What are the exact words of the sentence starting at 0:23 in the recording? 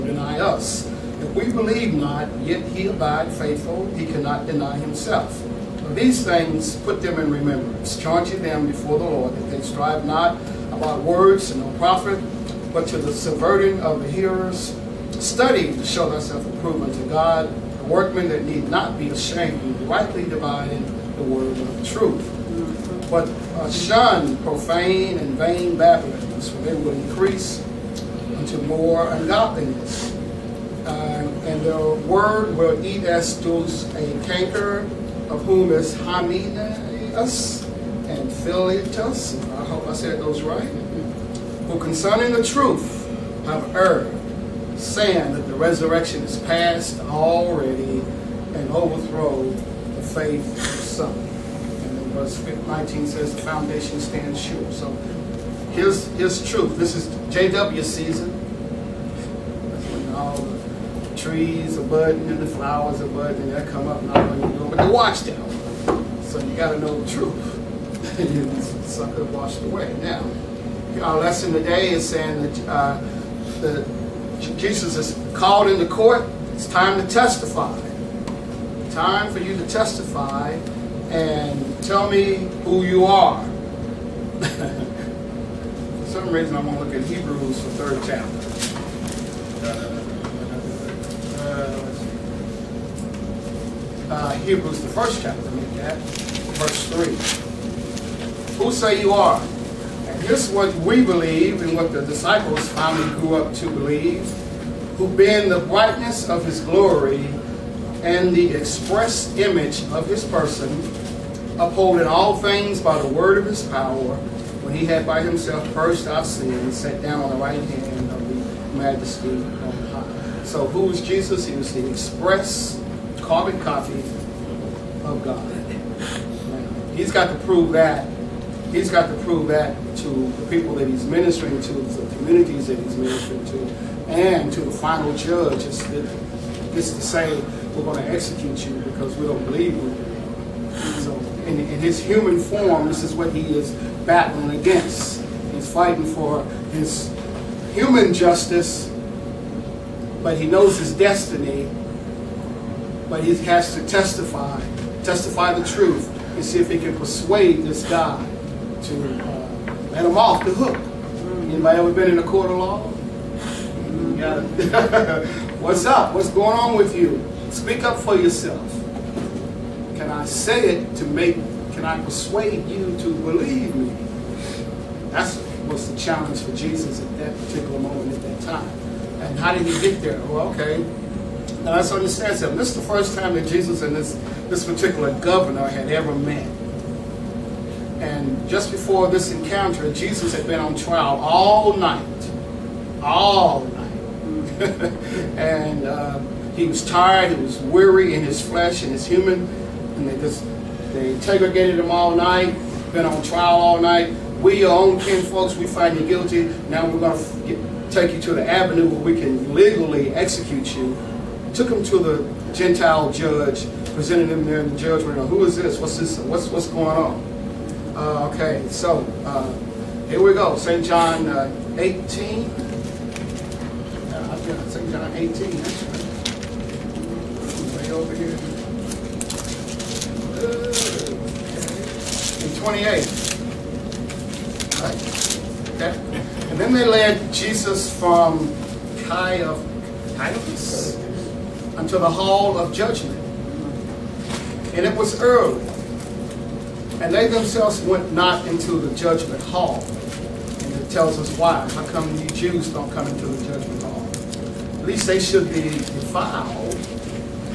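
But uh, shun profane and vain babblings, for they will increase unto more ungodliness.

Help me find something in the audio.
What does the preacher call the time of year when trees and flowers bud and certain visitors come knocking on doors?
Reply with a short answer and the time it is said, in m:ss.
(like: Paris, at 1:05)
J.W. season, at 0:57.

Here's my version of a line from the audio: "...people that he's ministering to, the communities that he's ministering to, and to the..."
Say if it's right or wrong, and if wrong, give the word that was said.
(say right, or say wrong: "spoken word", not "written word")
right.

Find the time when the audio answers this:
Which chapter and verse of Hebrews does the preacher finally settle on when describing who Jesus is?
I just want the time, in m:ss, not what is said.
1:34.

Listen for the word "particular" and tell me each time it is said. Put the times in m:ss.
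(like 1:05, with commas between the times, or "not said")
2:57, 3:04.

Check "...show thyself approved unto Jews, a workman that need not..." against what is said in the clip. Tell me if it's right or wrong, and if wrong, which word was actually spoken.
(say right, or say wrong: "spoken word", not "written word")
wrong: "God", not "Jews".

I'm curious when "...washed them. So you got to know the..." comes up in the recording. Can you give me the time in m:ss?
1:04.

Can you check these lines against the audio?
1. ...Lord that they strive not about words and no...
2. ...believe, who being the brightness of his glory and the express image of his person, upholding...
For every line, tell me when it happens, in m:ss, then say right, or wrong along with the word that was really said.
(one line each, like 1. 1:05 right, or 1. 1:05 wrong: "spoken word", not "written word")
1. 0:09 right
2. 1:43 right.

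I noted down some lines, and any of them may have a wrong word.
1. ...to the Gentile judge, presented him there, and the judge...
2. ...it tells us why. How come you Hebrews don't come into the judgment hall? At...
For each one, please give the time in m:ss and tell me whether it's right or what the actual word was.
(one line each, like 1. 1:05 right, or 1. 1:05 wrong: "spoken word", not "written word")
1. 3:31 right
2. 4:10 wrong: "Jews", not "Hebrews".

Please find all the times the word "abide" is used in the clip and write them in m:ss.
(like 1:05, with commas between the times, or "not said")
0:02.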